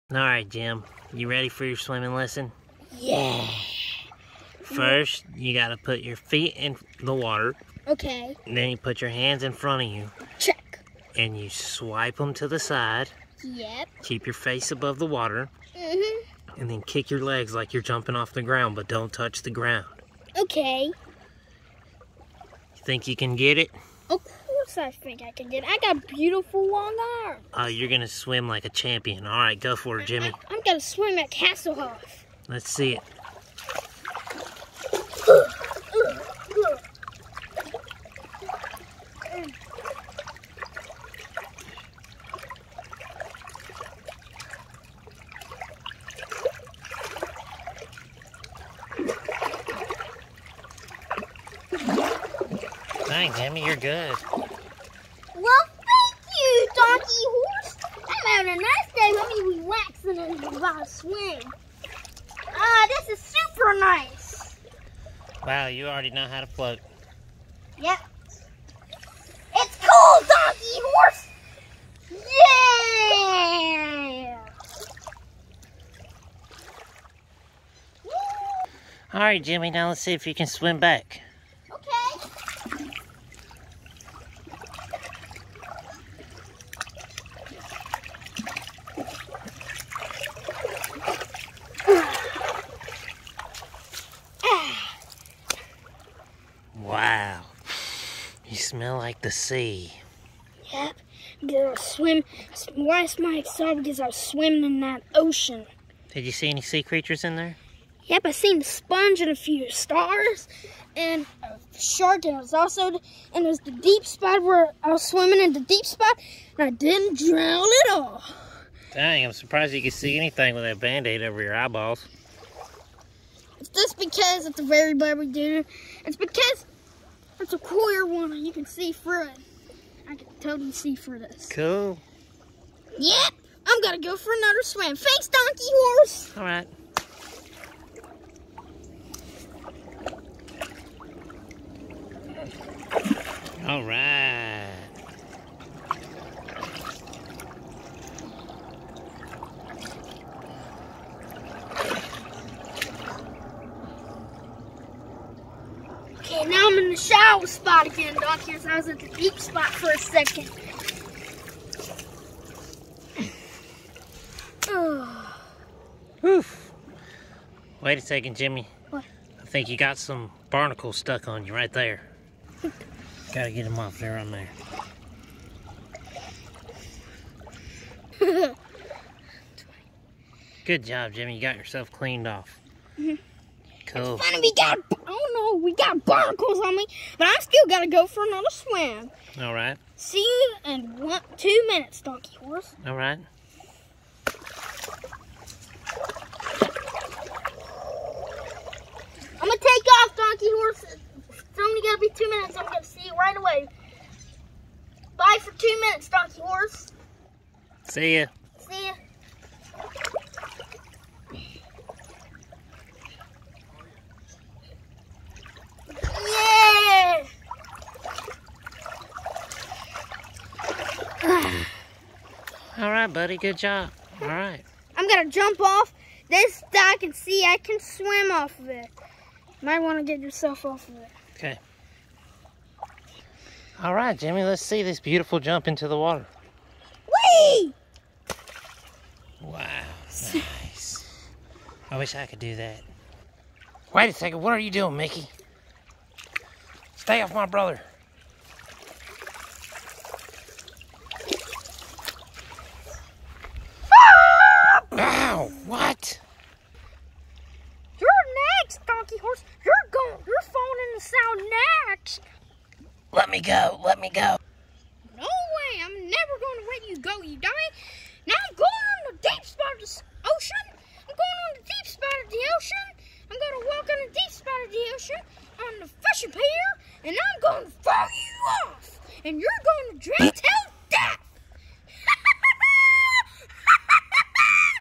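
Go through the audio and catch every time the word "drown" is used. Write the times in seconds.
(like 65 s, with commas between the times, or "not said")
117 s, 280 s.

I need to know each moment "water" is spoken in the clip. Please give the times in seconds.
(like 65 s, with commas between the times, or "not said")
7 s, 15 s, 235 s.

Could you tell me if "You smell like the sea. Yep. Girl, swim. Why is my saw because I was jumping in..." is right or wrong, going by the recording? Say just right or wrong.
wrong.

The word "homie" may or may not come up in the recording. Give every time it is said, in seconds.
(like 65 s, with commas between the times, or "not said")
59 s.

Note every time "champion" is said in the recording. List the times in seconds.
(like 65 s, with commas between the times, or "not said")
28 s.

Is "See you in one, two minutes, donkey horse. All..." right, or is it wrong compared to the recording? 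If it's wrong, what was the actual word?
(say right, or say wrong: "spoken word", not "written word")
right.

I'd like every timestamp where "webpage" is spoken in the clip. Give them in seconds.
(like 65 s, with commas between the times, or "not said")
not said.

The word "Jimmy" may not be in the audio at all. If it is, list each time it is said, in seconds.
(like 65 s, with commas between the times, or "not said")
30 s, 53 s, 79 s, 168 s, 181 s, 234 s.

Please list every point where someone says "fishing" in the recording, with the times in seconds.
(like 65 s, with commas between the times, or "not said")
276 s.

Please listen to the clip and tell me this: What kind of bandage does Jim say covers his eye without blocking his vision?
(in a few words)
a clear one.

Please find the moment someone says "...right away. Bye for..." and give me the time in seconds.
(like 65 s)
203 s.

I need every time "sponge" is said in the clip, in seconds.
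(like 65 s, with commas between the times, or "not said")
108 s.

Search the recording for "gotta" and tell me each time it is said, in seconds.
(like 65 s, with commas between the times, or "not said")
5 s, 173 s.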